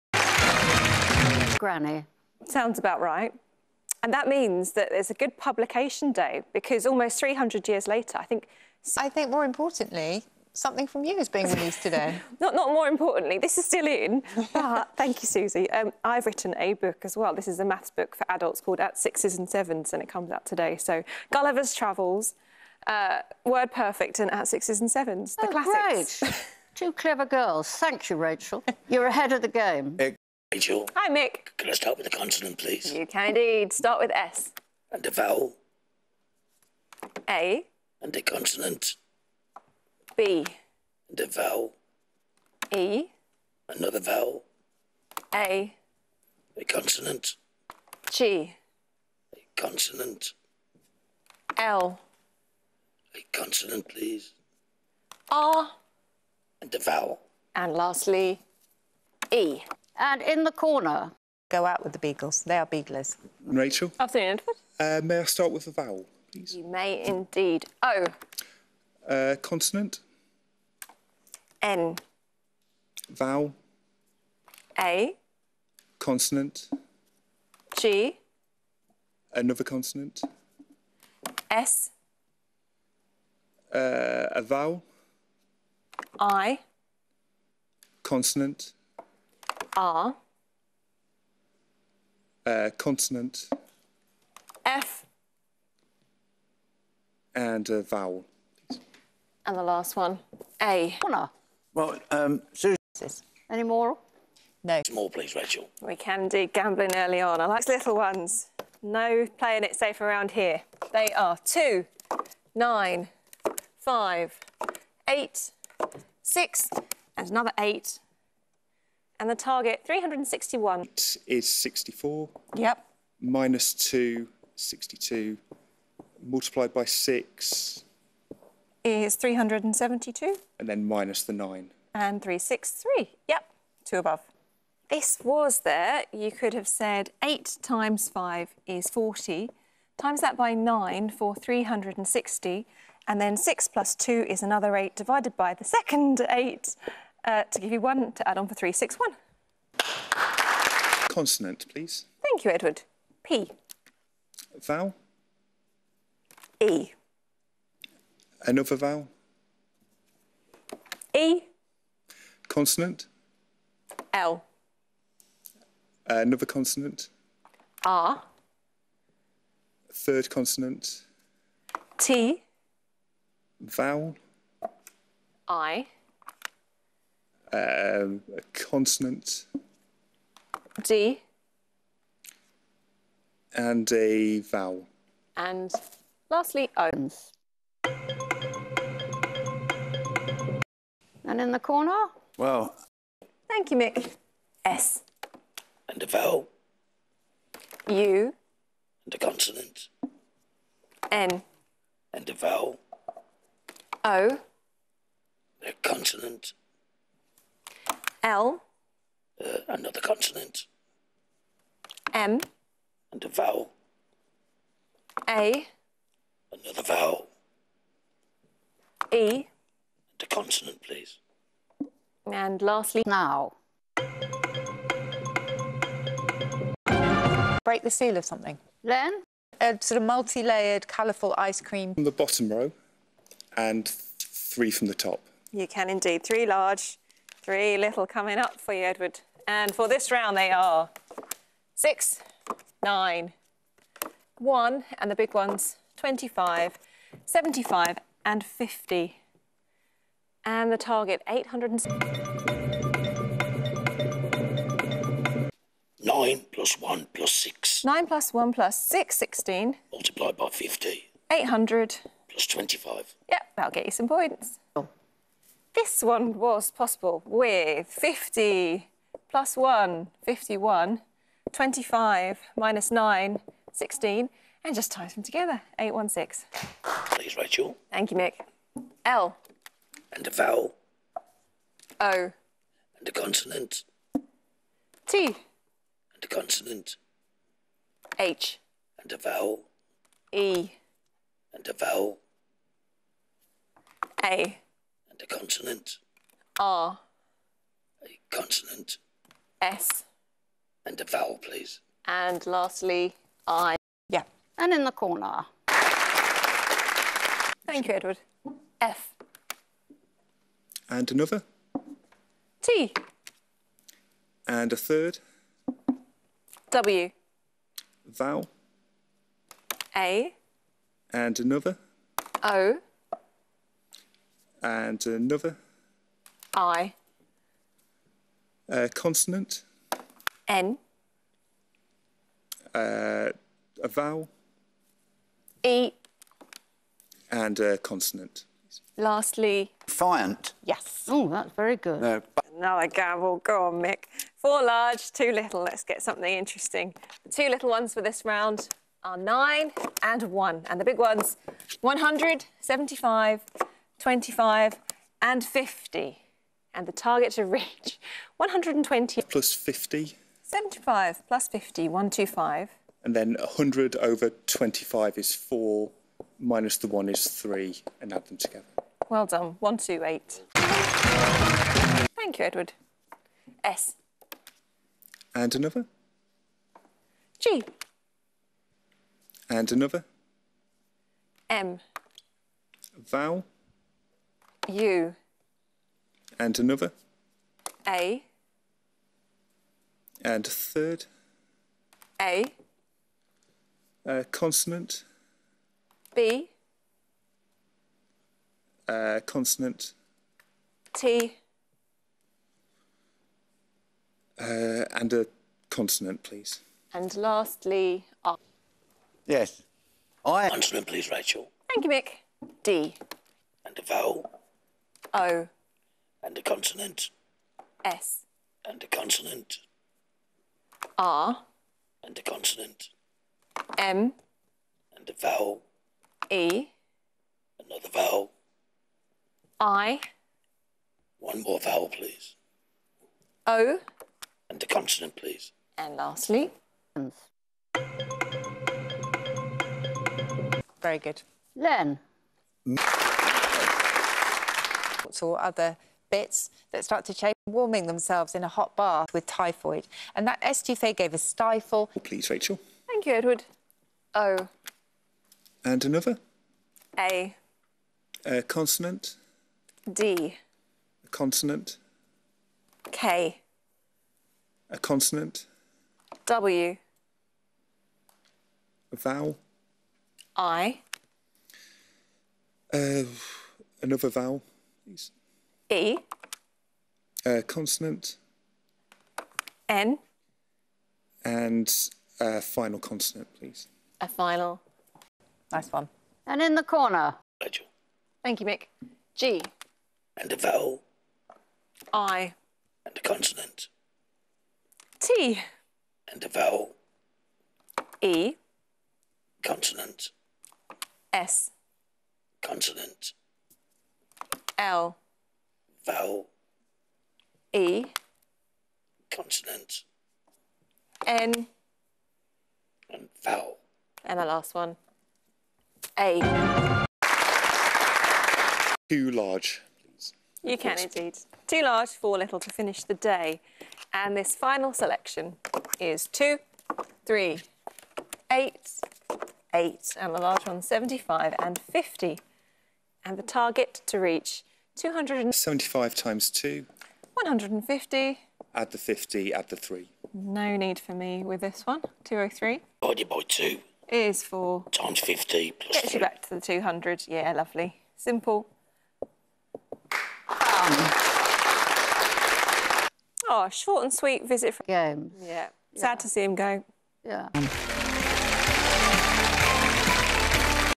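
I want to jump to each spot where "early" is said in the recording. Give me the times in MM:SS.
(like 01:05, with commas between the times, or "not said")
01:46.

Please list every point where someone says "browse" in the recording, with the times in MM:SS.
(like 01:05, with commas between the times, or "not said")
not said.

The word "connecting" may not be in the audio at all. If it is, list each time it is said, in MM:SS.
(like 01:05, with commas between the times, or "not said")
not said.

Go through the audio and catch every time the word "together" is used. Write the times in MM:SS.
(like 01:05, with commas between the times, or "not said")
04:35, 06:08.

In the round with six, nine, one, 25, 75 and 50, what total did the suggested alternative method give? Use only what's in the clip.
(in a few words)
816.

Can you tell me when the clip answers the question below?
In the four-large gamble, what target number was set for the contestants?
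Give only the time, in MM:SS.
05:58.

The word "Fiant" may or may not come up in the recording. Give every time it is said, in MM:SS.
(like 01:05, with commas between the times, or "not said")
05:39.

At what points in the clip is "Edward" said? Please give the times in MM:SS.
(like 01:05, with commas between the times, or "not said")
01:04, 02:32, 03:58, 05:07, 06:12, 07:33.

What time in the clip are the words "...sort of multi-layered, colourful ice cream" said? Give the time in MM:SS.
03:49.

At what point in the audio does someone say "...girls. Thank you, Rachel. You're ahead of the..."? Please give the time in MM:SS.
00:27.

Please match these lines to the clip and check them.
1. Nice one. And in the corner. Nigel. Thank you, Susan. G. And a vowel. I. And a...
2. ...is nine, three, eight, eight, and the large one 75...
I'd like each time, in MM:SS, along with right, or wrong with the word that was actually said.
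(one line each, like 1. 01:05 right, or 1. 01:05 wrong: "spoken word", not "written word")
1. 08:05 wrong: "Mick", not "Susan"
2. 08:45 wrong: "two", not "nine".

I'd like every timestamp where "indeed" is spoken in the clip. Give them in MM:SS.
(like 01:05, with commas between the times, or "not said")
00:33, 01:07, 03:55, 08:40.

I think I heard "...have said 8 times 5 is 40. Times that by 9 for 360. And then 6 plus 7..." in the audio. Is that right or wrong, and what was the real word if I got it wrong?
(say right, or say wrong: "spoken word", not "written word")
wrong: "2", not "7".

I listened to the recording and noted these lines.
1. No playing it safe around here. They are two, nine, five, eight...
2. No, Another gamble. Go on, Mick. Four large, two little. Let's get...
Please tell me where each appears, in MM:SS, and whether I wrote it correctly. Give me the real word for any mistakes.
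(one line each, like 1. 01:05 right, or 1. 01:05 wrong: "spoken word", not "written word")
1. 01:48 right
2. 05:42 right.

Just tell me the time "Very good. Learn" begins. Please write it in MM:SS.
07:20.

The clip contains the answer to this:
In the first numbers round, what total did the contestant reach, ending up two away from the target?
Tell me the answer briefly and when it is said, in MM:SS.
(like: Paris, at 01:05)
363, at 02:12.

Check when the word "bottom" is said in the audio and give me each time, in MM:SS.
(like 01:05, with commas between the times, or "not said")
03:52.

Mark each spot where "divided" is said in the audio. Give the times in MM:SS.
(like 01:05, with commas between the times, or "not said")
02:24, 09:02.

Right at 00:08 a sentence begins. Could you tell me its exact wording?
I think more importantly, something from you is being released today.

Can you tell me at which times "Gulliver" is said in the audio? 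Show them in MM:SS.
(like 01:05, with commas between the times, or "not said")
00:21.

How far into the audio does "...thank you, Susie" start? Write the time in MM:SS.
00:14.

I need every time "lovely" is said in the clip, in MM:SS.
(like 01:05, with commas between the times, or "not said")
09:07.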